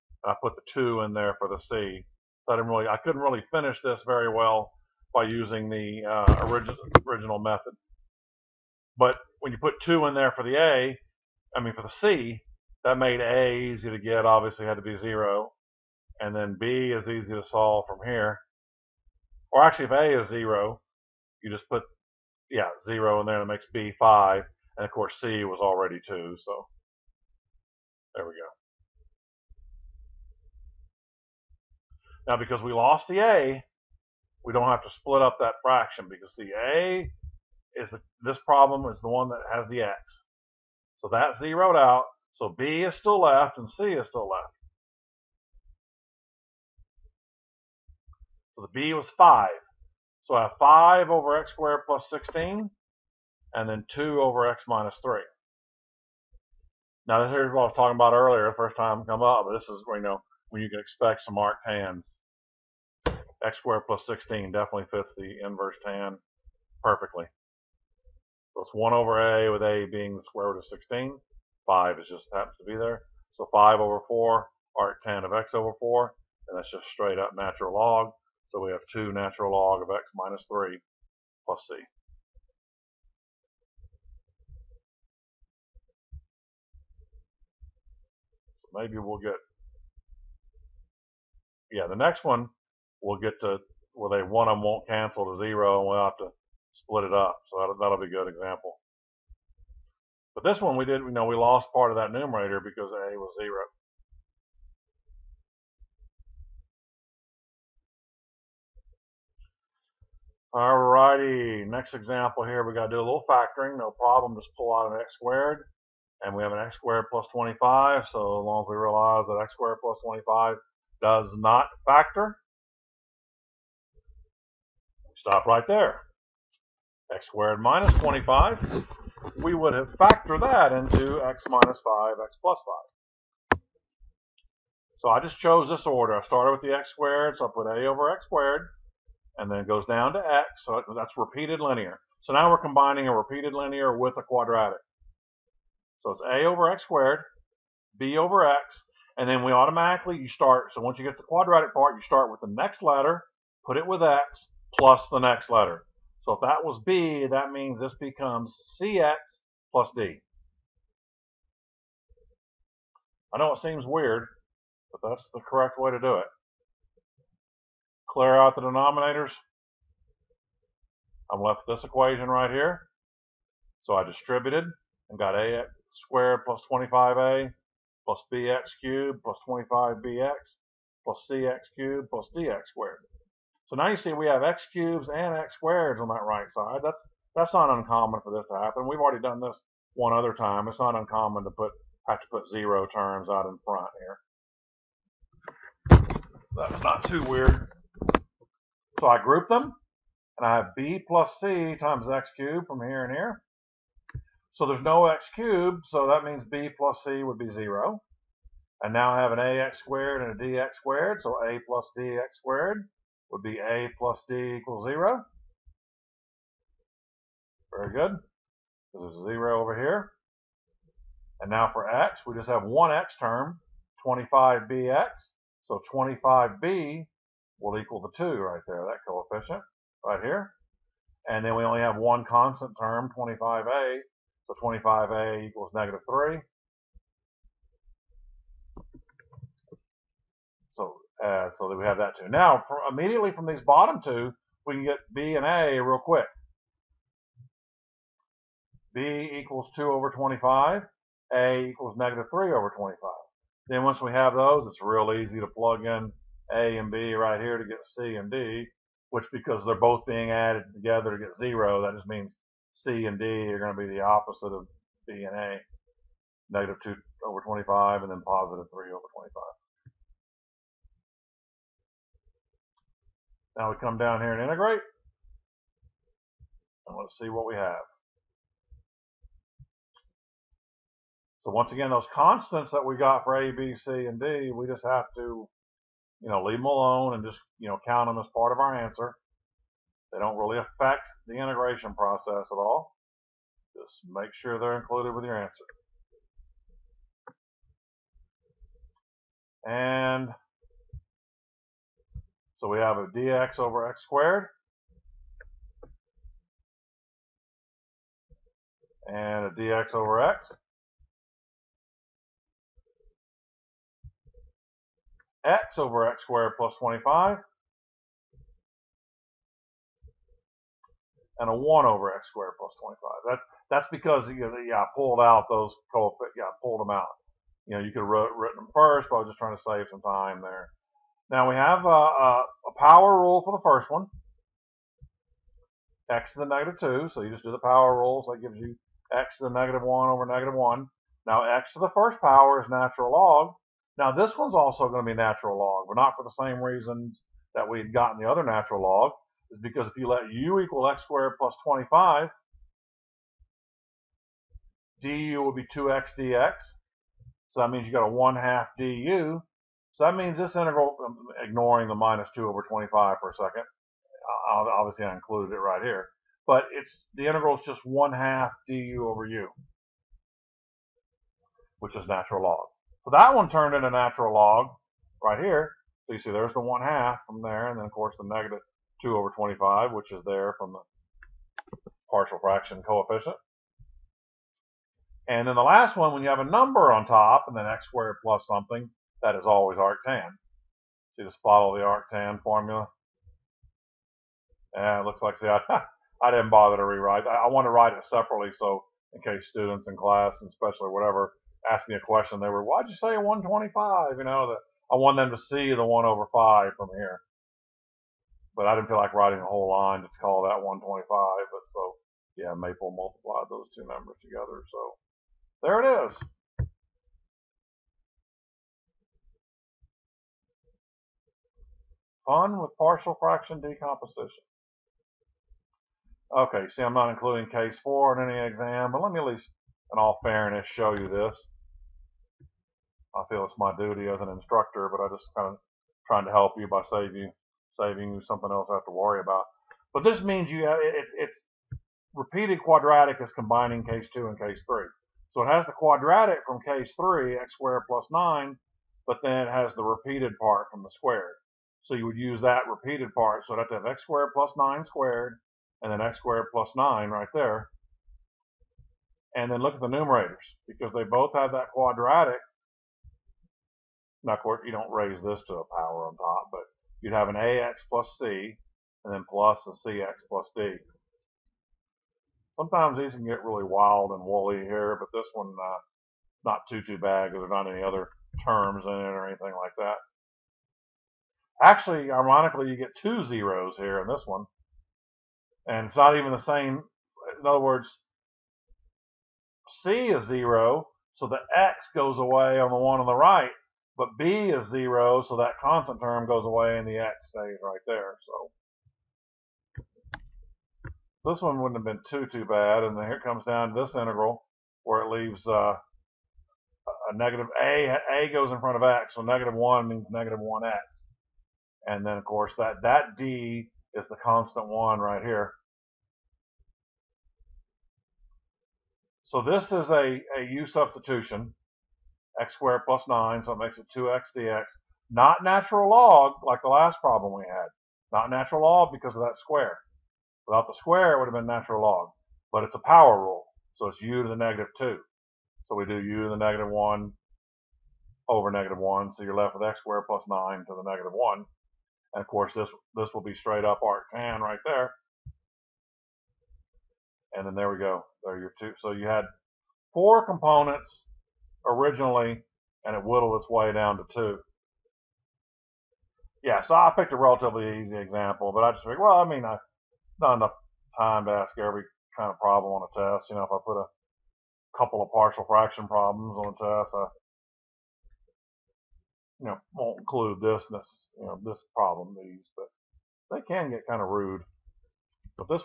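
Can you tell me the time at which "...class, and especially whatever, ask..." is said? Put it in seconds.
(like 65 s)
399 s.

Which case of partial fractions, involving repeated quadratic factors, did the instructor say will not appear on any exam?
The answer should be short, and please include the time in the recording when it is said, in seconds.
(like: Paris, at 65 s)
case four, at 427 s.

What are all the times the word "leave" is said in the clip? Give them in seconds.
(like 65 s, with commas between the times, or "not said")
286 s, 505 s.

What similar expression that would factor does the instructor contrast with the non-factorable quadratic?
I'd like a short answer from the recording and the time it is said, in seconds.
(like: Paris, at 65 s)
x squared minus 25, at 127 s.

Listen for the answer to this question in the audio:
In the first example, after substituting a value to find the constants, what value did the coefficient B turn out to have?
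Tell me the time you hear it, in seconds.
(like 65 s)
23 s.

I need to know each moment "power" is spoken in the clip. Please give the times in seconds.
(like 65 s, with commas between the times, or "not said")
332 s, 337 s, 342 s, 465 s, 532 s.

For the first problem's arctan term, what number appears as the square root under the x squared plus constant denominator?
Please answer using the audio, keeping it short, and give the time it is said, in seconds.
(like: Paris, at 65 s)
4, at 73 s.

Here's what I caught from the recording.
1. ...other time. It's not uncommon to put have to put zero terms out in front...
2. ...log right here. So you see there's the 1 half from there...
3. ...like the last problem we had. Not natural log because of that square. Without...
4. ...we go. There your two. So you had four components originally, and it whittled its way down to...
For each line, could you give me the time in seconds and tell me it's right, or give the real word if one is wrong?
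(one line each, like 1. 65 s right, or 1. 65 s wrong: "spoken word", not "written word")
1. 190 s right
2. 374 s right
3. 526 s right
4. 547 s right.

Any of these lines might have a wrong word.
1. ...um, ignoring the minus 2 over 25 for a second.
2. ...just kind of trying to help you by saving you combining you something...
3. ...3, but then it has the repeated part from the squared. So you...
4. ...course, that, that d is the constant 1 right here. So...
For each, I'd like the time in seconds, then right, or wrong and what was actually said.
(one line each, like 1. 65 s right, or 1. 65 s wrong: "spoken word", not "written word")
1. 361 s right
2. 435 s wrong: "saving", not "combining"
3. 448 s wrong: "9", not "3"
4. 512 s right.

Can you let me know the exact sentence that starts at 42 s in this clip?
So B is still left and C is still left.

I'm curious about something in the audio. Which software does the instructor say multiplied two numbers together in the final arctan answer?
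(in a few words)
Maple.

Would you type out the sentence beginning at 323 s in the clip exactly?
That's, that's because, you know, yeah, I pulled out those coefficients.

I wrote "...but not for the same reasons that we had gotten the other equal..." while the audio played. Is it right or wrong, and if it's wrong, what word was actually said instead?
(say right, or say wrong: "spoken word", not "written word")
wrong: "natural", not "equal".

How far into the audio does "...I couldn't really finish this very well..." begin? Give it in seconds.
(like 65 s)
2 s.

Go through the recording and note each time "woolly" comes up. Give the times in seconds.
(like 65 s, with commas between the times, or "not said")
474 s.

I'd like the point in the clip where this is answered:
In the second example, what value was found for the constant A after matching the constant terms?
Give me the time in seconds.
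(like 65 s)
251 s.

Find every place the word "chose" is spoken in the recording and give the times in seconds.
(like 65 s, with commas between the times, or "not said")
135 s.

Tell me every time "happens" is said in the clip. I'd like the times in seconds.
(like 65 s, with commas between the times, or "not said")
72 s, 188 s.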